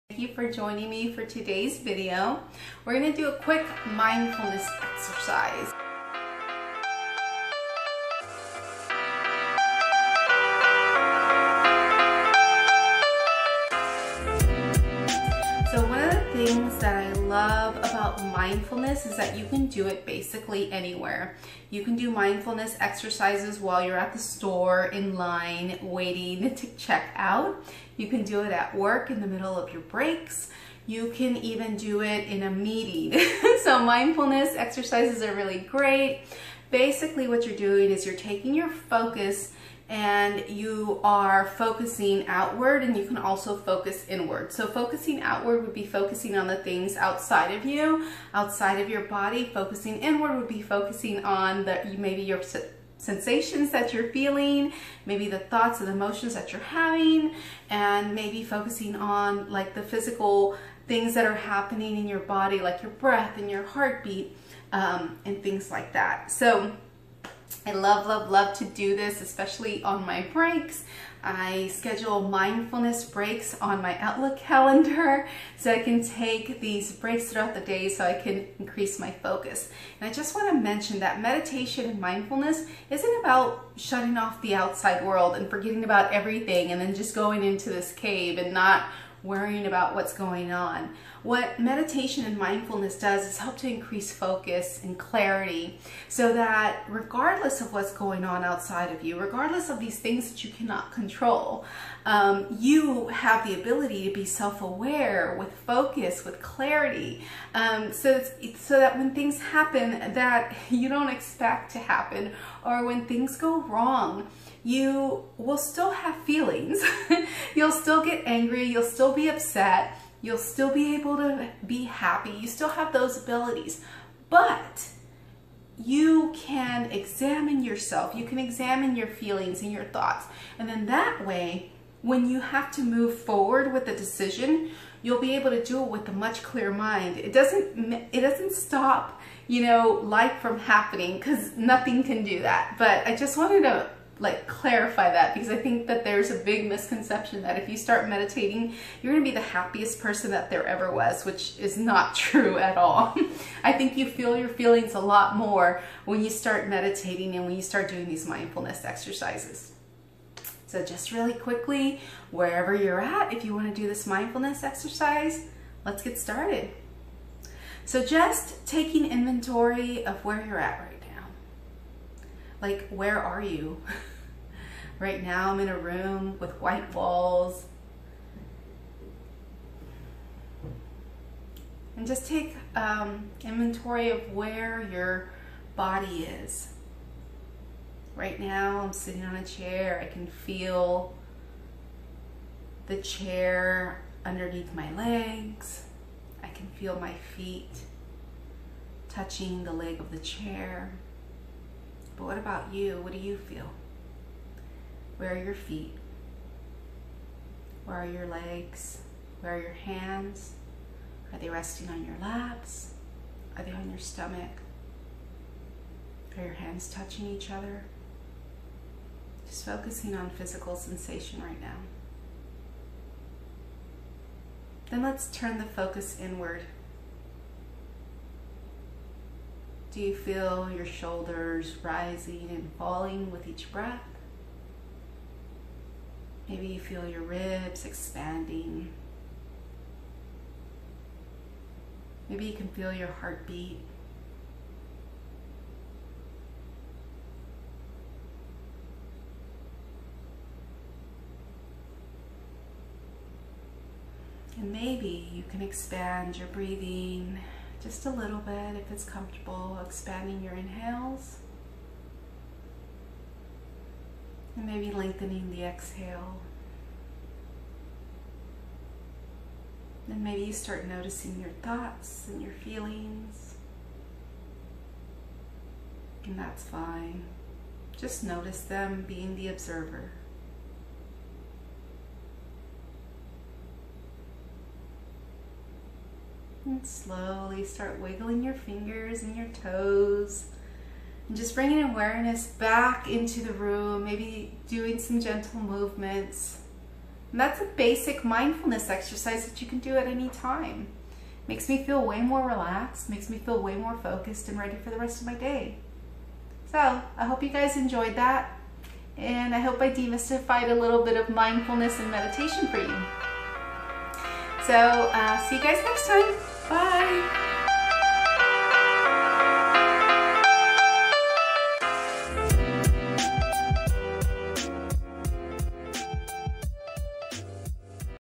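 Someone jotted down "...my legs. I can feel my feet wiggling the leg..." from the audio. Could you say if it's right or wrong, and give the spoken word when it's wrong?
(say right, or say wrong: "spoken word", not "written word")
wrong: "touching", not "wiggling".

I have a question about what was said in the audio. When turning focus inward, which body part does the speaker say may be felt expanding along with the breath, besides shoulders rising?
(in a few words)
Ribs.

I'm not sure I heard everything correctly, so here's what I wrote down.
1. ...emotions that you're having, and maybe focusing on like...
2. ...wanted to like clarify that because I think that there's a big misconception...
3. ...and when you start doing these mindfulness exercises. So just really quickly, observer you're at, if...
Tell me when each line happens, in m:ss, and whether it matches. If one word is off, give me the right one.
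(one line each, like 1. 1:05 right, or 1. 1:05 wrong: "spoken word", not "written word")
1. 0:55 right
2. 2:23 right
3. 2:37 wrong: "wherever", not "observer".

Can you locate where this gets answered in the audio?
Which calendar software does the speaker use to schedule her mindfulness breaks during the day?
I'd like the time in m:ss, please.
1:13.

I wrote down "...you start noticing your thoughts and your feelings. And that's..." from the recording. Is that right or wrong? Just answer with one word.
right.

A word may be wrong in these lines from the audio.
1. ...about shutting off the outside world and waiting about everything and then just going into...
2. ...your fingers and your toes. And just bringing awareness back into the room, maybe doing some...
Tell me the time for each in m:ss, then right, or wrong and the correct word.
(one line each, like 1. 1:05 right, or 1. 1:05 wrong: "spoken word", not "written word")
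1. 1:23 wrong: "forgetting", not "waiting"
2. 4:48 right.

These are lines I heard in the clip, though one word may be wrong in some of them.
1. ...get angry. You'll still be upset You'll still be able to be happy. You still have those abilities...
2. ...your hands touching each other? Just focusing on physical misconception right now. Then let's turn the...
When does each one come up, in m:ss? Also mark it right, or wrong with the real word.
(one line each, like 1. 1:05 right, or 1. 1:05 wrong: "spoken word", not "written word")
1. 1:58 right
2. 3:36 wrong: "sensation", not "misconception".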